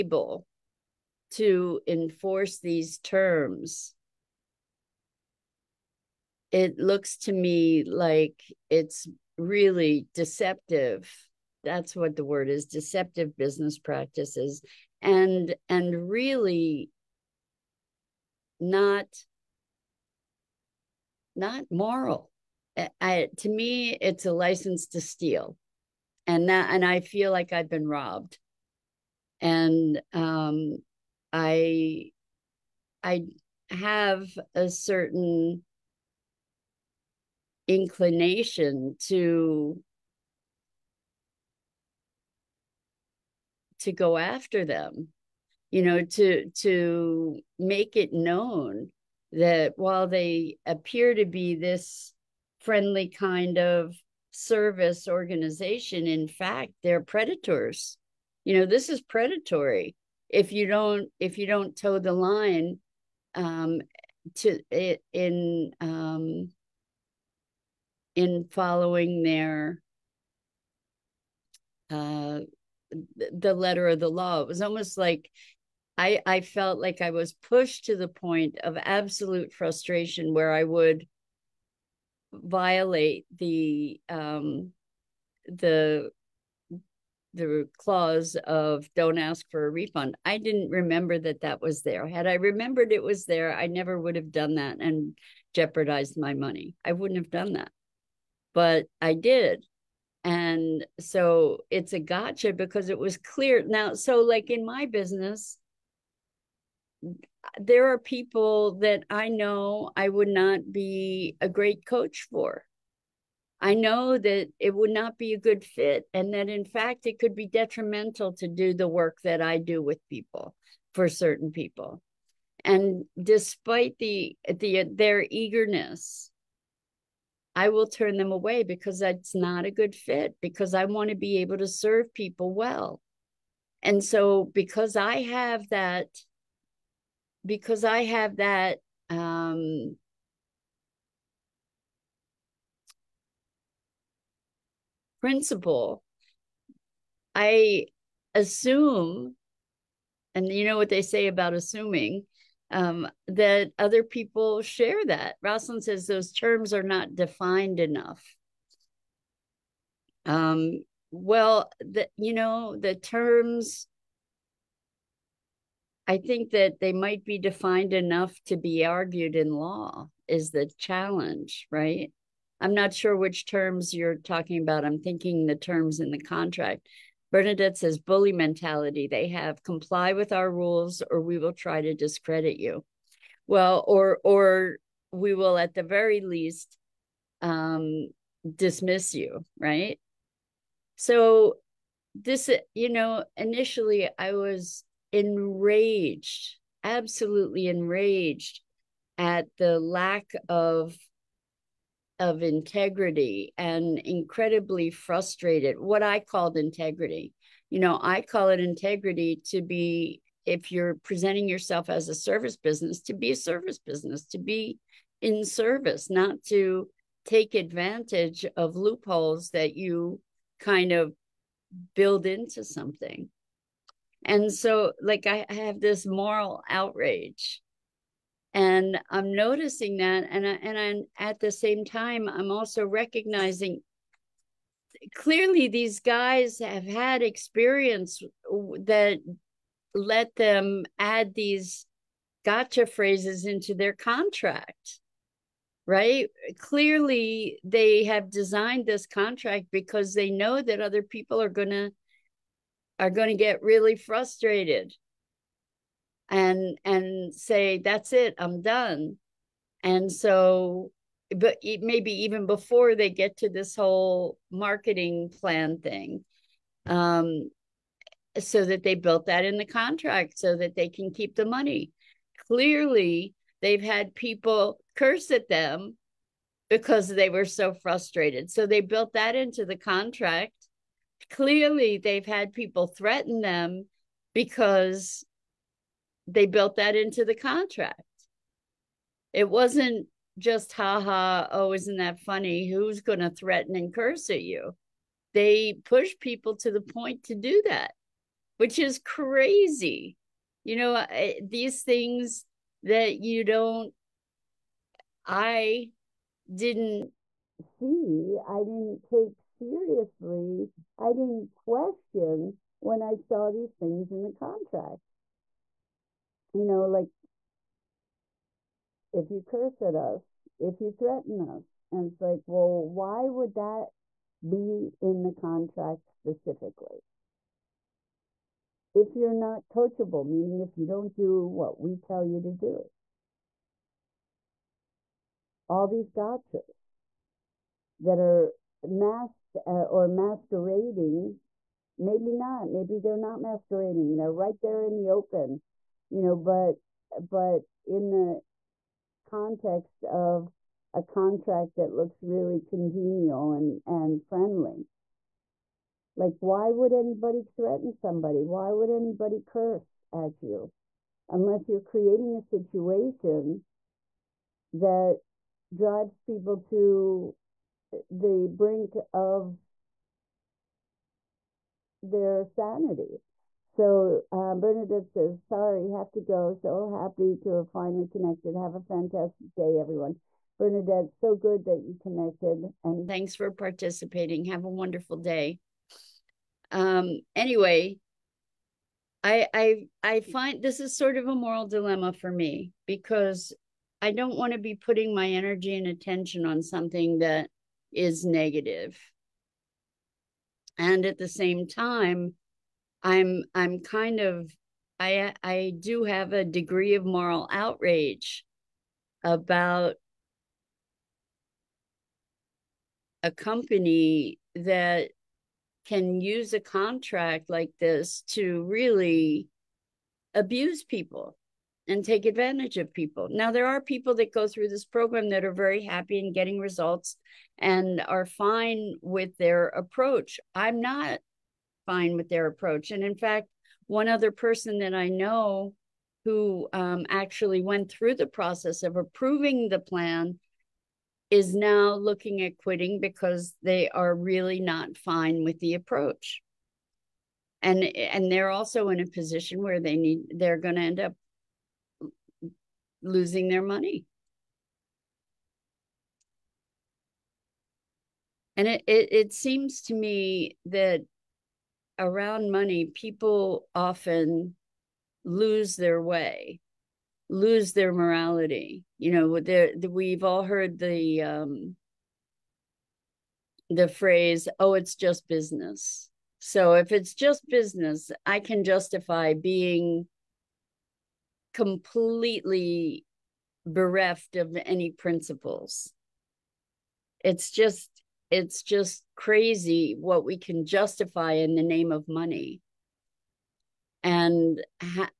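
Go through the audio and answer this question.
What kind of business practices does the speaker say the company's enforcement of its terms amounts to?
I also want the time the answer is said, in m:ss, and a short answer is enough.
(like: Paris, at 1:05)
Deceptive business practices, at 0:12.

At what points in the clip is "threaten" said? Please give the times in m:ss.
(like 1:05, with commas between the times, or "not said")
4:42, 4:53, 5:20, 5:57.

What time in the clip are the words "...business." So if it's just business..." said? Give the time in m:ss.
7:55.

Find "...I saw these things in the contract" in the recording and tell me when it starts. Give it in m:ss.
5:13.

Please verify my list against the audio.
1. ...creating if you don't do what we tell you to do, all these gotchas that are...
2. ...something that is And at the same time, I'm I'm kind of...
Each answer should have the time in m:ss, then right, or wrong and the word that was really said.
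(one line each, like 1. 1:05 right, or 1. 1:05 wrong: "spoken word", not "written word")
1. 5:30 wrong: "meaning", not "creating"
2. 6:36 right.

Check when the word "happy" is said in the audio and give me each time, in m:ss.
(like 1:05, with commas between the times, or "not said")
6:16, 7:05.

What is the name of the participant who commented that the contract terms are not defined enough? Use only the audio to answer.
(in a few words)
Rosalind.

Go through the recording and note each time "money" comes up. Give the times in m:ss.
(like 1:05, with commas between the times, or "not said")
1:36, 4:31, 7:33, 7:42, 8:12.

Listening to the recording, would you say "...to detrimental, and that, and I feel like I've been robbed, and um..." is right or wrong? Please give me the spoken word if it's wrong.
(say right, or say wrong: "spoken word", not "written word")
wrong: "steal", not "detrimental".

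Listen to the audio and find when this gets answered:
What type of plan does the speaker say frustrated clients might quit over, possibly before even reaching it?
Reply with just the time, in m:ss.
4:24.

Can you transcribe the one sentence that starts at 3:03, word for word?
Well, or or we will at the very least um dismiss you, right?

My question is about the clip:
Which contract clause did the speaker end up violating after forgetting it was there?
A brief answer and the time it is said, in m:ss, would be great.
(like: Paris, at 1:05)
Don't ask for a refund, at 1:28.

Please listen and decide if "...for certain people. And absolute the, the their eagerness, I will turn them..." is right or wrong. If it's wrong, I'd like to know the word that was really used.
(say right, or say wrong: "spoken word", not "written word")
wrong: "despite", not "absolute".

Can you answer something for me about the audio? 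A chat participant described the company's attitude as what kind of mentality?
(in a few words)
Bully mentality.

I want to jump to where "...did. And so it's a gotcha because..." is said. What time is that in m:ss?
1:39.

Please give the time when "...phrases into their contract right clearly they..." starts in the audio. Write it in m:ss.
4:02.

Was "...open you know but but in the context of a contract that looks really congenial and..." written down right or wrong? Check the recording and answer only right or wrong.
right.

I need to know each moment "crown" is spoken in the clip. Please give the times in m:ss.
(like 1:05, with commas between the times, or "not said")
not said.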